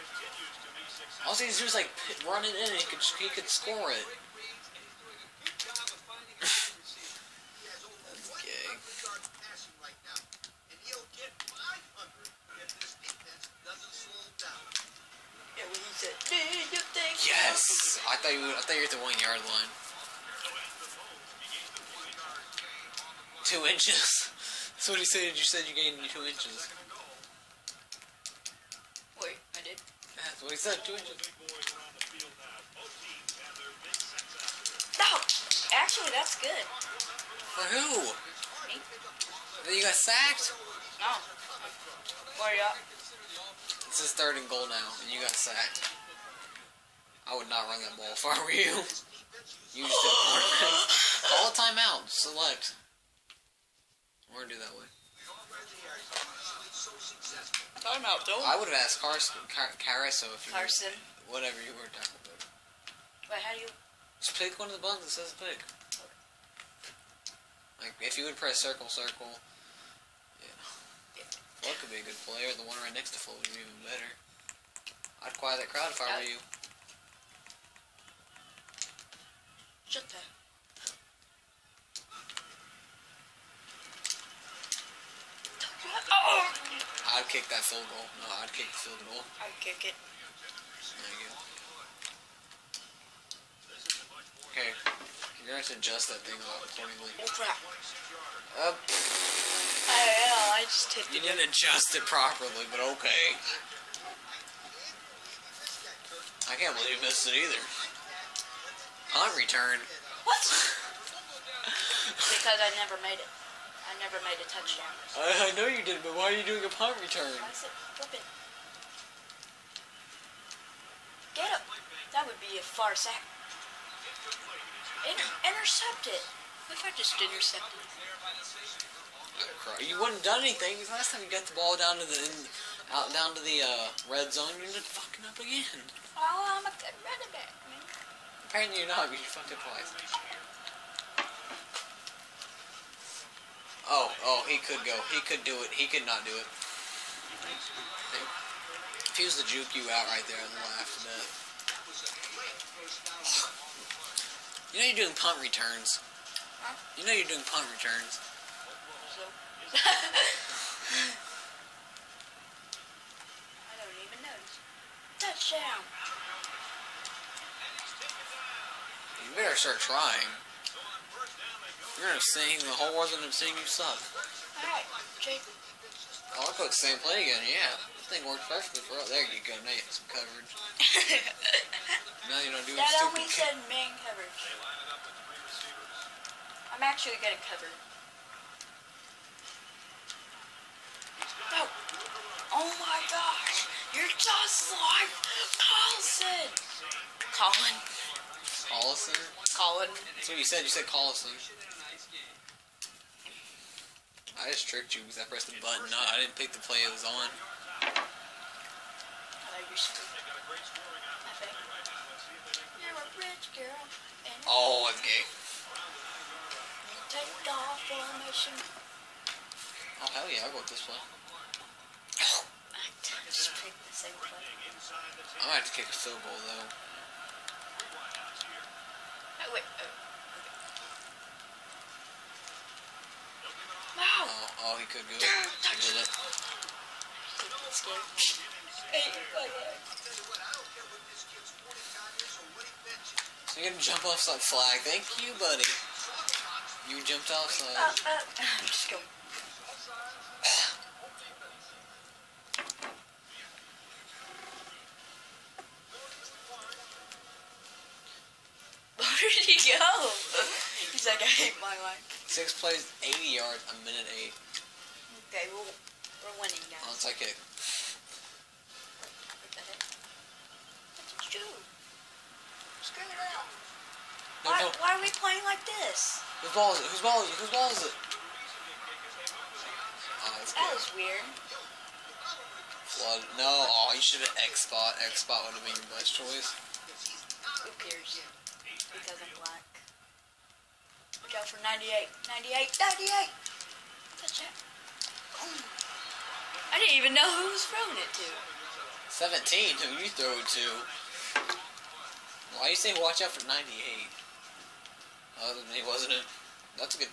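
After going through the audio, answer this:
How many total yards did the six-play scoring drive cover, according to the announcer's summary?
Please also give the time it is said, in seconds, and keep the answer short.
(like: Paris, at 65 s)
80 yards, at 263 s.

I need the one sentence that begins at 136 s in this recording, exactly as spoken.
Oh, I'm a good running back.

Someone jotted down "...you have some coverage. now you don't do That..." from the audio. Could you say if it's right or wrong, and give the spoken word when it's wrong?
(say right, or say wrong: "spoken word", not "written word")
right.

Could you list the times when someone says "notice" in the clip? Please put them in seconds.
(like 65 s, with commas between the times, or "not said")
164 s.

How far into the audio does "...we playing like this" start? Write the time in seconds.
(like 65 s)
275 s.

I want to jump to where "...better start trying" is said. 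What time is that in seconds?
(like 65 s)
169 s.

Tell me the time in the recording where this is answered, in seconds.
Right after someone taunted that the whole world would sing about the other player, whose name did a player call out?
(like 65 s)
175 s.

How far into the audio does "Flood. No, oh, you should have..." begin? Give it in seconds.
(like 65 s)
282 s.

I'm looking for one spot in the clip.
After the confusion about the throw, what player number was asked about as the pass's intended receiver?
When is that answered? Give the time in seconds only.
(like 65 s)
299 s.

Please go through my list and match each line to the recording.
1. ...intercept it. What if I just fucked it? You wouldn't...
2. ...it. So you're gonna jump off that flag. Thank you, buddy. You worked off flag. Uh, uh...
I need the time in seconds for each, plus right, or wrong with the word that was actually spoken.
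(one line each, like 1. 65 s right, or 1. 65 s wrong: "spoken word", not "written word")
1. 125 s wrong: "intercepted", not "fucked"
2. 235 s wrong: "jumped", not "worked".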